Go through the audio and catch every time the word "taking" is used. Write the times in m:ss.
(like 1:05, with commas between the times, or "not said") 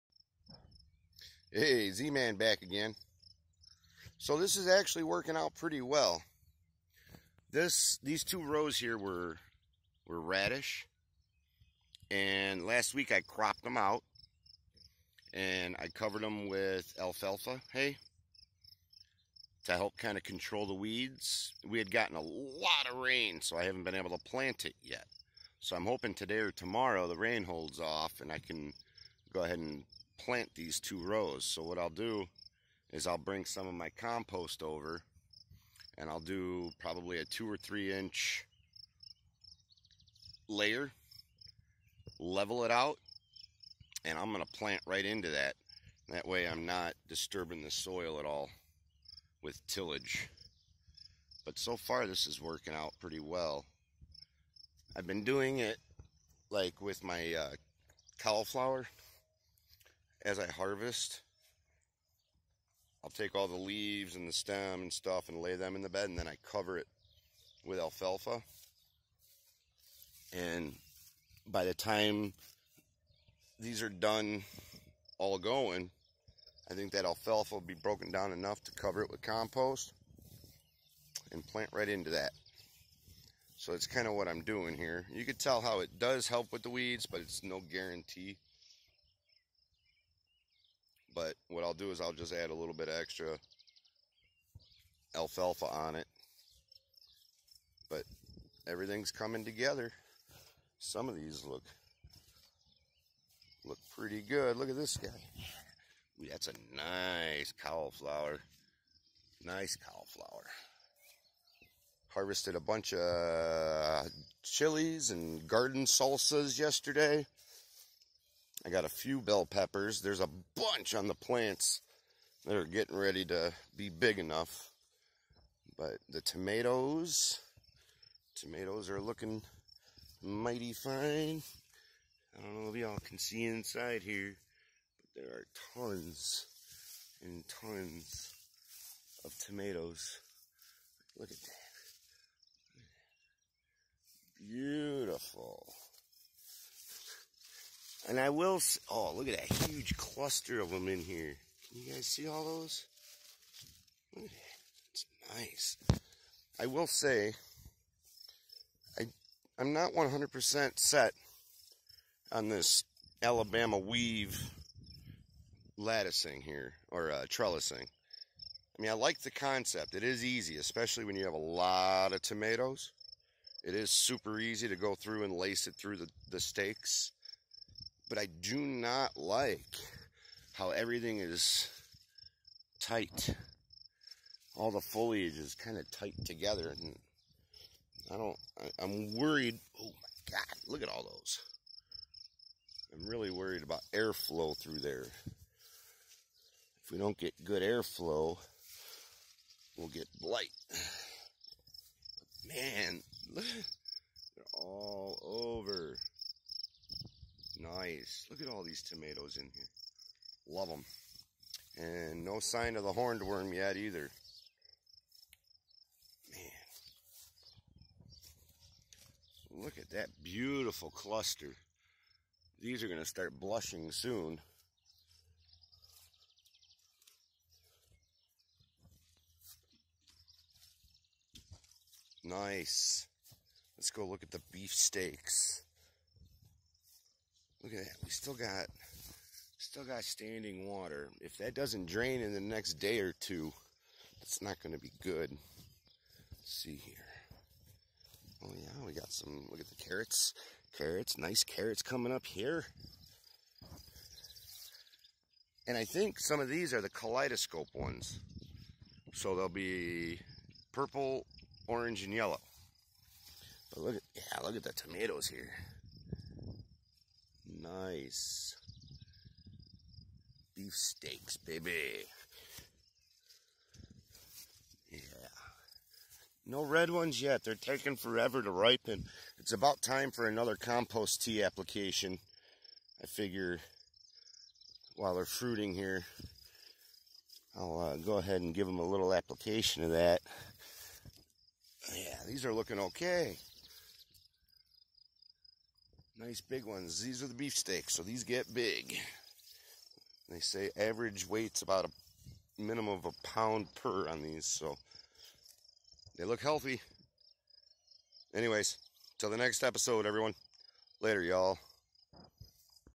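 4:37.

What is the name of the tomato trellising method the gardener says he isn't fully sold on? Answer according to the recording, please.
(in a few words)
Alabama weave.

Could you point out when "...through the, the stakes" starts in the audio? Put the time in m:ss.
2:55.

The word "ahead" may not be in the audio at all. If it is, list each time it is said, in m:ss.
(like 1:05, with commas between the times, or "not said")
0:29, 4:48.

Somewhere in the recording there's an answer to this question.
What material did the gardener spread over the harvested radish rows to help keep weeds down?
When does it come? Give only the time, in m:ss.
0:16.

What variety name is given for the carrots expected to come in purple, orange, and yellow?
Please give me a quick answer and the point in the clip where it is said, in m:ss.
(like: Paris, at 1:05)
Kaleidoscope, at 4:16.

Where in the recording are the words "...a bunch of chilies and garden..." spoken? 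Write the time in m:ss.
1:52.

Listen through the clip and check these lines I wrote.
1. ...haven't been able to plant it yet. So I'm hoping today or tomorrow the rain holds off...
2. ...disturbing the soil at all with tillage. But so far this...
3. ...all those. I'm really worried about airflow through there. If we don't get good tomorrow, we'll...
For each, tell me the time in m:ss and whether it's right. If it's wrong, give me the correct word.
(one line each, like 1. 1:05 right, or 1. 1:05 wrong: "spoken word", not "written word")
1. 0:23 right
2. 0:47 right
3. 3:10 wrong: "airflow", not "tomorrow".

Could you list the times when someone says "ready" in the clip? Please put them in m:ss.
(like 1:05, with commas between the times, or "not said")
2:02.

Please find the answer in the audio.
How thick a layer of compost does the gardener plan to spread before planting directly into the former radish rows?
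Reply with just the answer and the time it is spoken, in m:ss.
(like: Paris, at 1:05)
2 or 3 inches, at 0:37.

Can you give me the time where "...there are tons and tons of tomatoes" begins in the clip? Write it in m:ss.
2:15.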